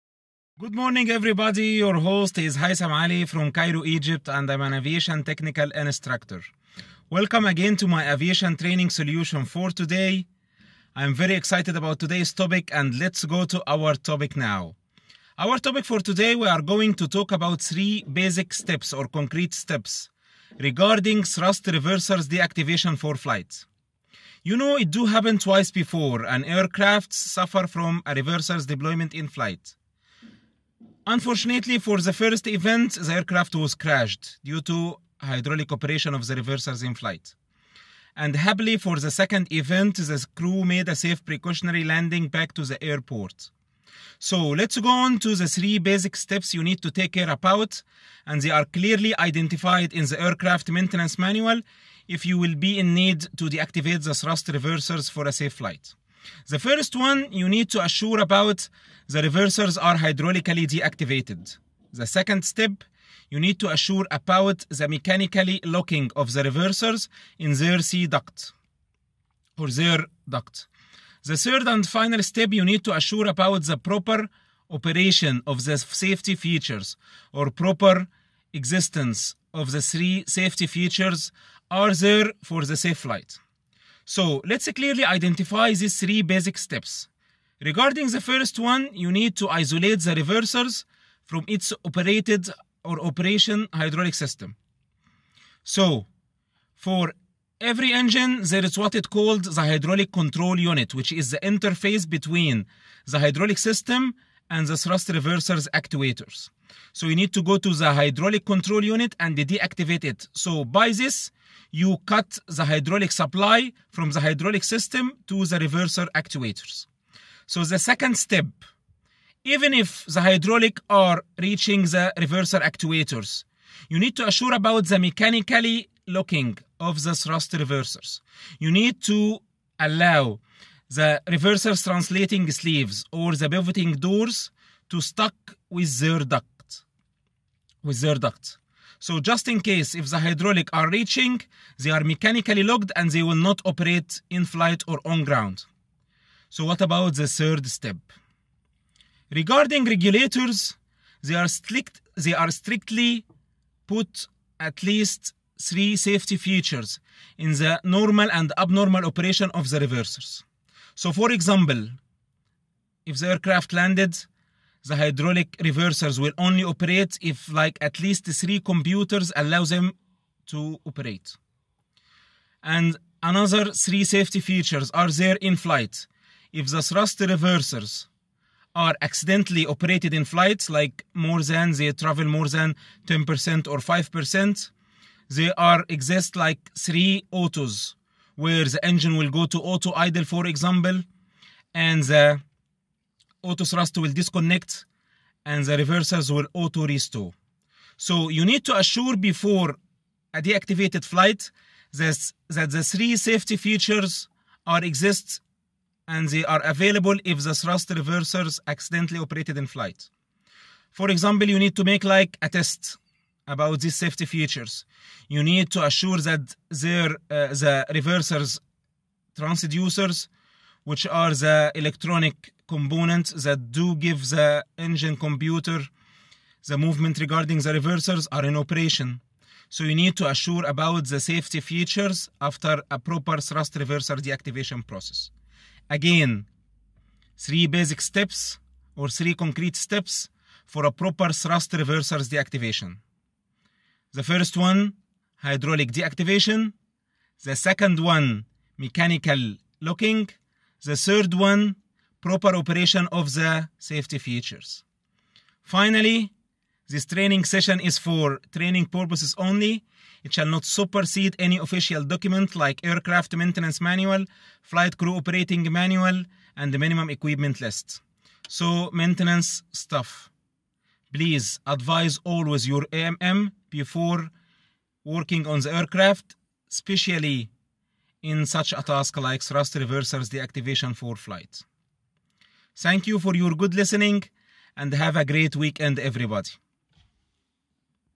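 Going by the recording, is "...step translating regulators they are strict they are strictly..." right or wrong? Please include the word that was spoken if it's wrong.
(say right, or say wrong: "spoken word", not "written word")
wrong: "regarding", not "translating".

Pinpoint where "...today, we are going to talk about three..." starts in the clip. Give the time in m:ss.
0:15.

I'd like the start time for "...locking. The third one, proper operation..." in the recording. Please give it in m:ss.
4:09.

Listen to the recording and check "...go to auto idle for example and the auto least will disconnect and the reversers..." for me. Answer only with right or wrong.
wrong.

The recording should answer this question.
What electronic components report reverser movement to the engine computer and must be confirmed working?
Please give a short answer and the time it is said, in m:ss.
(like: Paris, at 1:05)
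reversers transducers, at 3:37.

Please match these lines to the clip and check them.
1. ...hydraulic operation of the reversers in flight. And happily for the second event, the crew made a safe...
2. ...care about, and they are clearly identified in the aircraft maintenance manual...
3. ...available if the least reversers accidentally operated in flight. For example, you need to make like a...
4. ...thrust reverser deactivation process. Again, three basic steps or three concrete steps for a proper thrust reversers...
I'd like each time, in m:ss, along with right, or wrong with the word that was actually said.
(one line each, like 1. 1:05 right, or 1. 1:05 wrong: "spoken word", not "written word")
1. 0:35 right
2. 0:47 right
3. 3:26 wrong: "thrust", not "least"
4. 3:53 right.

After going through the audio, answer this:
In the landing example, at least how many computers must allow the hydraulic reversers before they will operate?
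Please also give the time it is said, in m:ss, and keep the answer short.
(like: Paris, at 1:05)
3, at 2:48.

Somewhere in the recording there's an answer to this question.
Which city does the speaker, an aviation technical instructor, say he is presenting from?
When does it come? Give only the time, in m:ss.
0:03.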